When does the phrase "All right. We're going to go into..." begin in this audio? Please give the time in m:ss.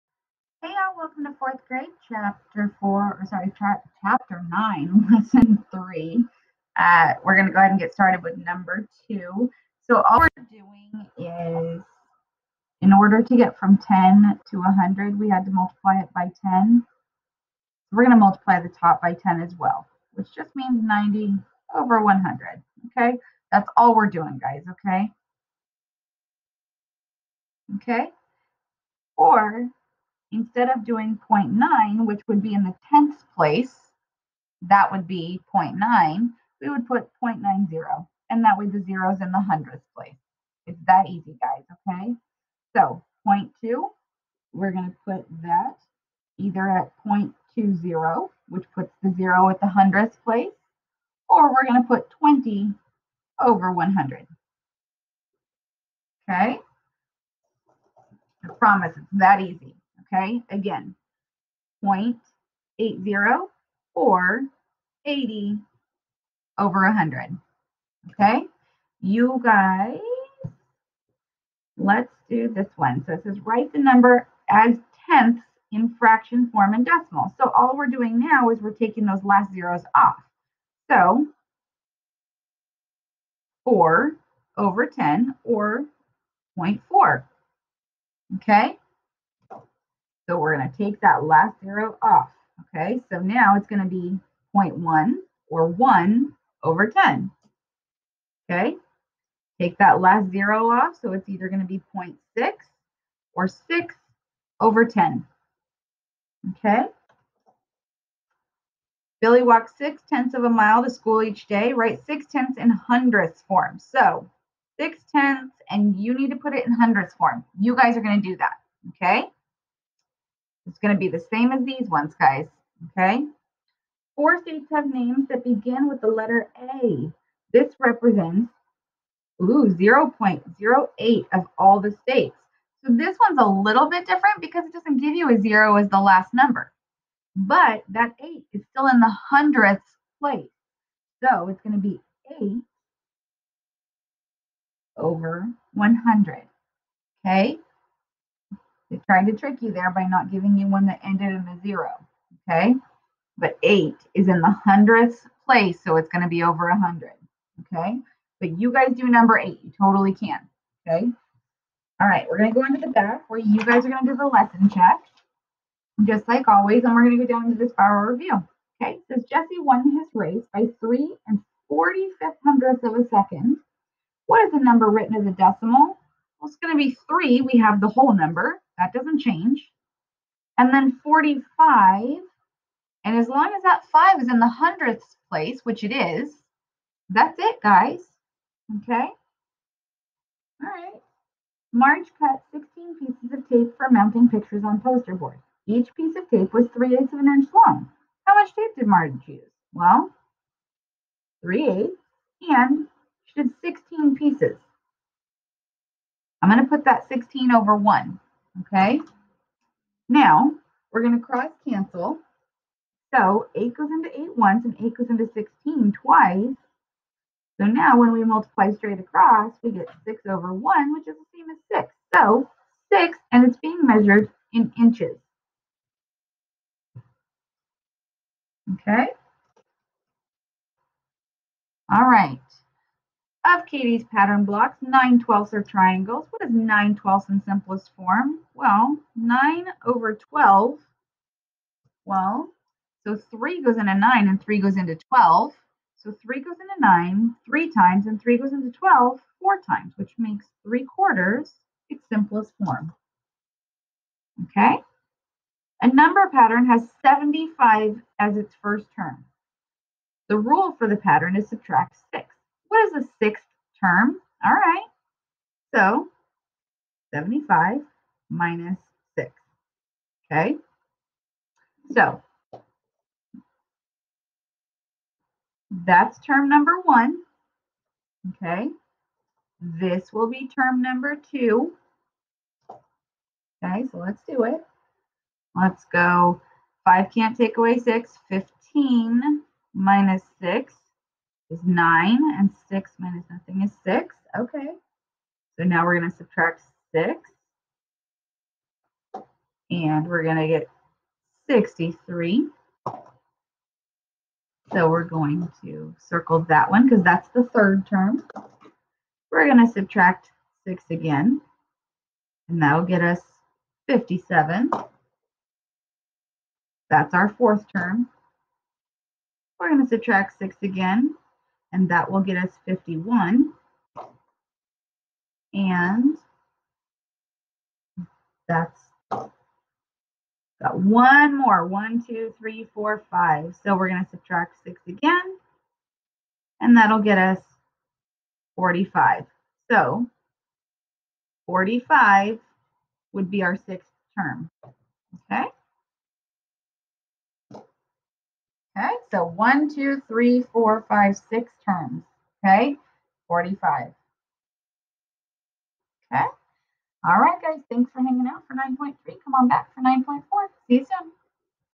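2:42.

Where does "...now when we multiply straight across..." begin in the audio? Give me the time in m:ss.
3:37.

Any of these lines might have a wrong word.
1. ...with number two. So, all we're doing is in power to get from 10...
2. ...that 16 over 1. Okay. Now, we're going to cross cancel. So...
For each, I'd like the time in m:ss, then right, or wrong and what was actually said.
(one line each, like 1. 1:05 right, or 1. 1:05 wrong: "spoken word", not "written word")
1. 0:08 wrong: "order", not "power"
2. 3:26 right.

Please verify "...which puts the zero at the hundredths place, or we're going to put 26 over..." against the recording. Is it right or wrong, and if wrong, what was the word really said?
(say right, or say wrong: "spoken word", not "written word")
wrong: "20", not "26".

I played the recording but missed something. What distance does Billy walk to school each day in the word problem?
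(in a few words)
six tenths of a mile.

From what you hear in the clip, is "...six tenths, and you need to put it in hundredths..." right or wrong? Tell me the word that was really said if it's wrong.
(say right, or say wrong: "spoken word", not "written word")
right.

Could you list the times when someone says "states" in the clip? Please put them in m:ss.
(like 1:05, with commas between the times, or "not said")
2:04, 2:11.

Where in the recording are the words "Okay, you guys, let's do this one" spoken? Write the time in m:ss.
1:08.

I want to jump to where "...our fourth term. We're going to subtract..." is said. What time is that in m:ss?
5:17.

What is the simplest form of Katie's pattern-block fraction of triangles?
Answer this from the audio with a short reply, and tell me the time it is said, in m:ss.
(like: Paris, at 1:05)
3/4, at 4:10.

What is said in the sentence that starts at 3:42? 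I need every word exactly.
So 6, and it's being measured in inches.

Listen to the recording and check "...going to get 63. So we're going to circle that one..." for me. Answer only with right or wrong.
right.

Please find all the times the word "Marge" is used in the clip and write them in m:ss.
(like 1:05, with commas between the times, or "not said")
3:11, 3:18.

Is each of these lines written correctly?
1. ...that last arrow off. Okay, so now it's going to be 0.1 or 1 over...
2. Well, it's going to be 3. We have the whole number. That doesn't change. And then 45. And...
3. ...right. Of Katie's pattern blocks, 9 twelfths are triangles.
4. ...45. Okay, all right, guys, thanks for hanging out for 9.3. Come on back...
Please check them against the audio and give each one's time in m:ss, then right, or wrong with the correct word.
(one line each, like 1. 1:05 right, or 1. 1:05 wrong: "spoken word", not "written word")
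1. 1:31 right
2. 2:56 right
3. 3:52 right
4. 5:53 right.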